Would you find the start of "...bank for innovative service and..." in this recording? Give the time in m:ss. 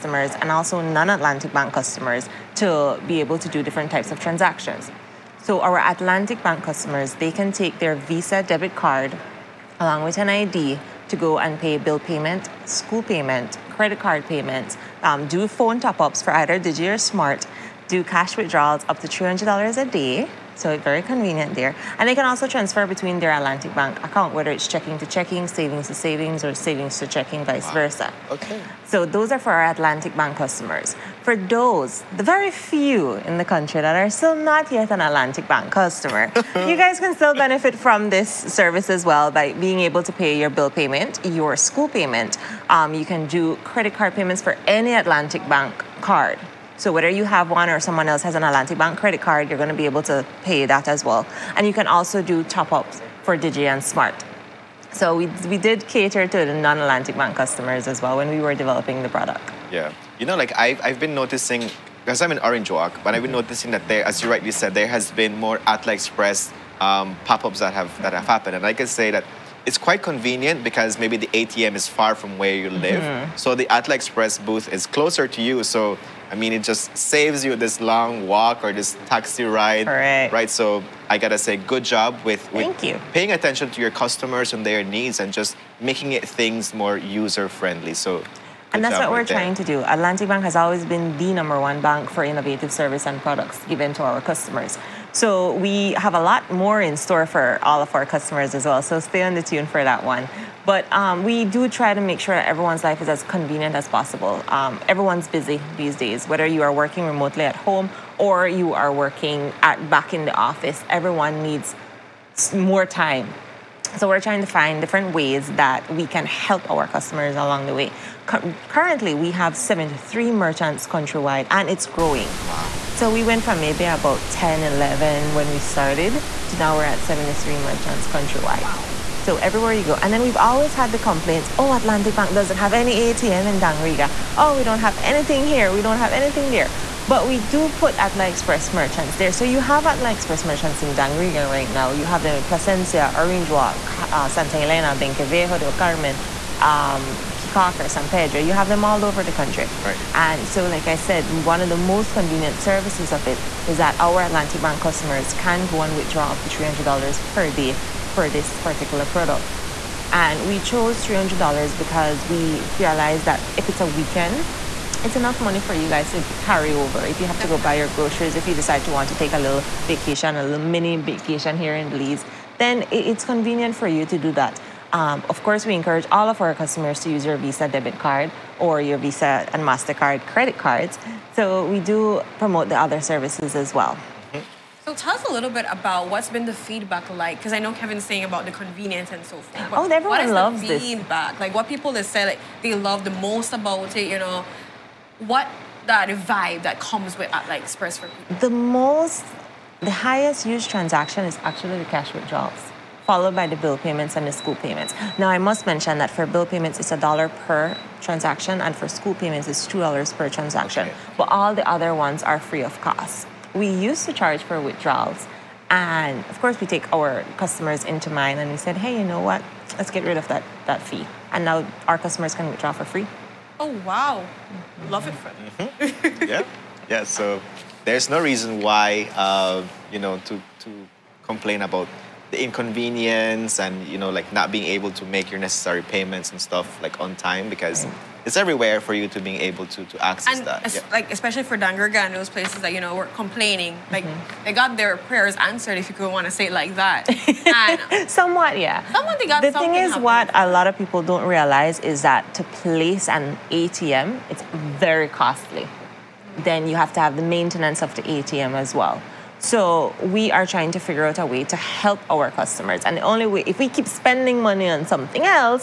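1:31.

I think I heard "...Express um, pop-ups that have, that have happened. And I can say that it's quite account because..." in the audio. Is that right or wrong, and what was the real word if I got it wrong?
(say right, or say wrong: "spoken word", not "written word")
wrong: "convenient", not "account".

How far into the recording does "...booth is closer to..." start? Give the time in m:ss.
1:14.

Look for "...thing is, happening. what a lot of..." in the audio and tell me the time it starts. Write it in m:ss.
4:09.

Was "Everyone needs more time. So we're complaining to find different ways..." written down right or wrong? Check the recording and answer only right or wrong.
wrong.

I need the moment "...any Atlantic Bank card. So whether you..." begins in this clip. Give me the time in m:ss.
0:44.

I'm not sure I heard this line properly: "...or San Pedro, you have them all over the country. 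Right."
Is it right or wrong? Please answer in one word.
right.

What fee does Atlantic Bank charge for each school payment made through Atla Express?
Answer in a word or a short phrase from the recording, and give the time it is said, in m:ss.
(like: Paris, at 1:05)
$2, at 3:29.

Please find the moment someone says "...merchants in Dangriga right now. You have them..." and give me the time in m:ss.
2:20.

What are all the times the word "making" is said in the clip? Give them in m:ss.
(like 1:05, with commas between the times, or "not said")
1:25.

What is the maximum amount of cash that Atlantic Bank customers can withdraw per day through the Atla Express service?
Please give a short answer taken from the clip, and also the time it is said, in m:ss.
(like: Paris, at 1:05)
$300, at 0:19.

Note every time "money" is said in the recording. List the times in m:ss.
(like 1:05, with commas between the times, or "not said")
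2:45, 4:24.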